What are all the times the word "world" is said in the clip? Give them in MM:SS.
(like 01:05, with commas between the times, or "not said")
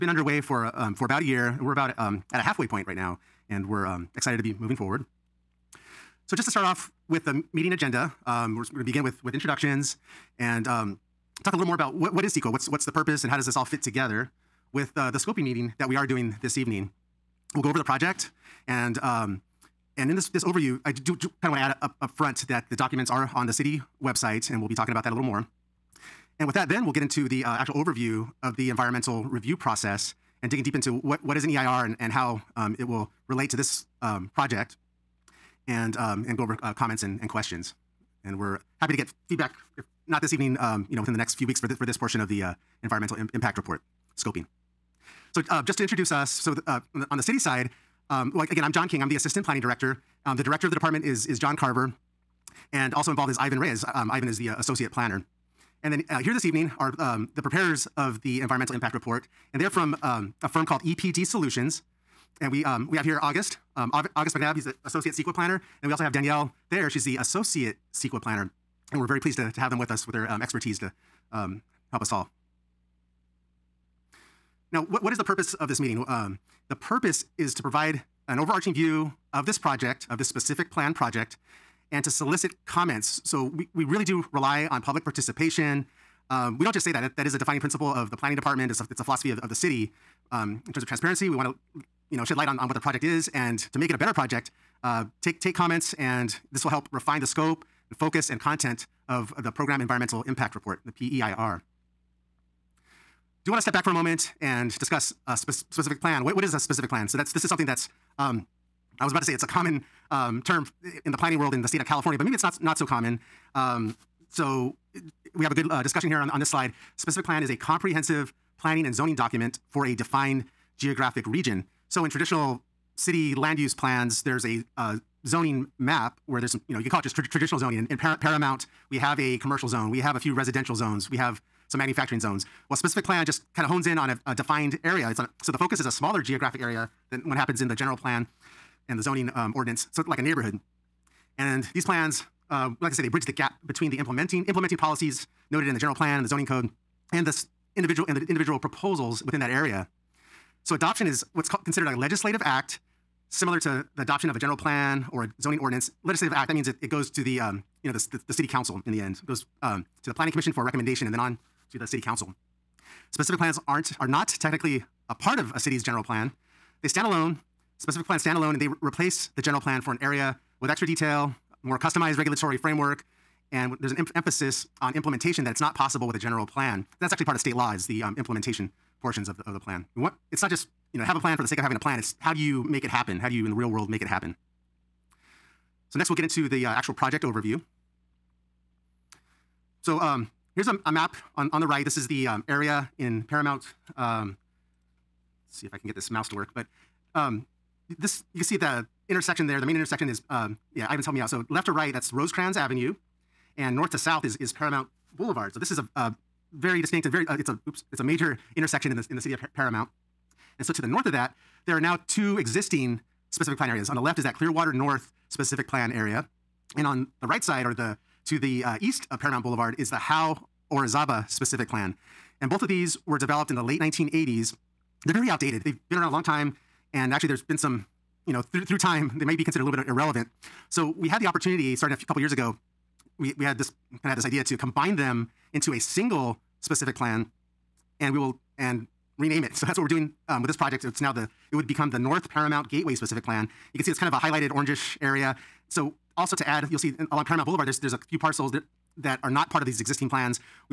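01:51, 03:03.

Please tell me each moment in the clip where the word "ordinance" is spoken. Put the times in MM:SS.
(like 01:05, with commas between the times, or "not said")
02:19, 02:35.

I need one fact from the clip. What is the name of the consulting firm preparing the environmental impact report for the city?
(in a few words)
EPD Solutions.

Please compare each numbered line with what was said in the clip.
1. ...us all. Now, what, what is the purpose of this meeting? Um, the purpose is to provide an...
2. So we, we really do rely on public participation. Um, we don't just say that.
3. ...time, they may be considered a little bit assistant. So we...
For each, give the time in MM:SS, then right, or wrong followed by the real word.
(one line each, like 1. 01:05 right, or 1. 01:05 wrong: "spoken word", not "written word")
1. 01:12 right
2. 01:23 right
3. 03:48 wrong: "irrelevant", not "assistant".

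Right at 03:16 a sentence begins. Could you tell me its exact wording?
But um, this, you can see the intersection there, the main intersection is, um, yeah, Ivan's helped me out.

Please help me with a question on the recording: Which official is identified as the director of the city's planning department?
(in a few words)
John Carver.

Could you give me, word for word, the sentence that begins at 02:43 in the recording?
Specific plans aren't, are not technically a part of a city's general plan.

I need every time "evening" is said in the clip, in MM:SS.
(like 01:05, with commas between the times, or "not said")
00:16, 00:40, 00:56.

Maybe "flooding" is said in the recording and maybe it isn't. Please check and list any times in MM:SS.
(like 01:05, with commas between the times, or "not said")
not said.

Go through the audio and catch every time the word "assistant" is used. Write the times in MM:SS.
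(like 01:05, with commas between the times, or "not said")
00:49.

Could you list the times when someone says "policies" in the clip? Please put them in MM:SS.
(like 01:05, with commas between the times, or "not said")
02:24.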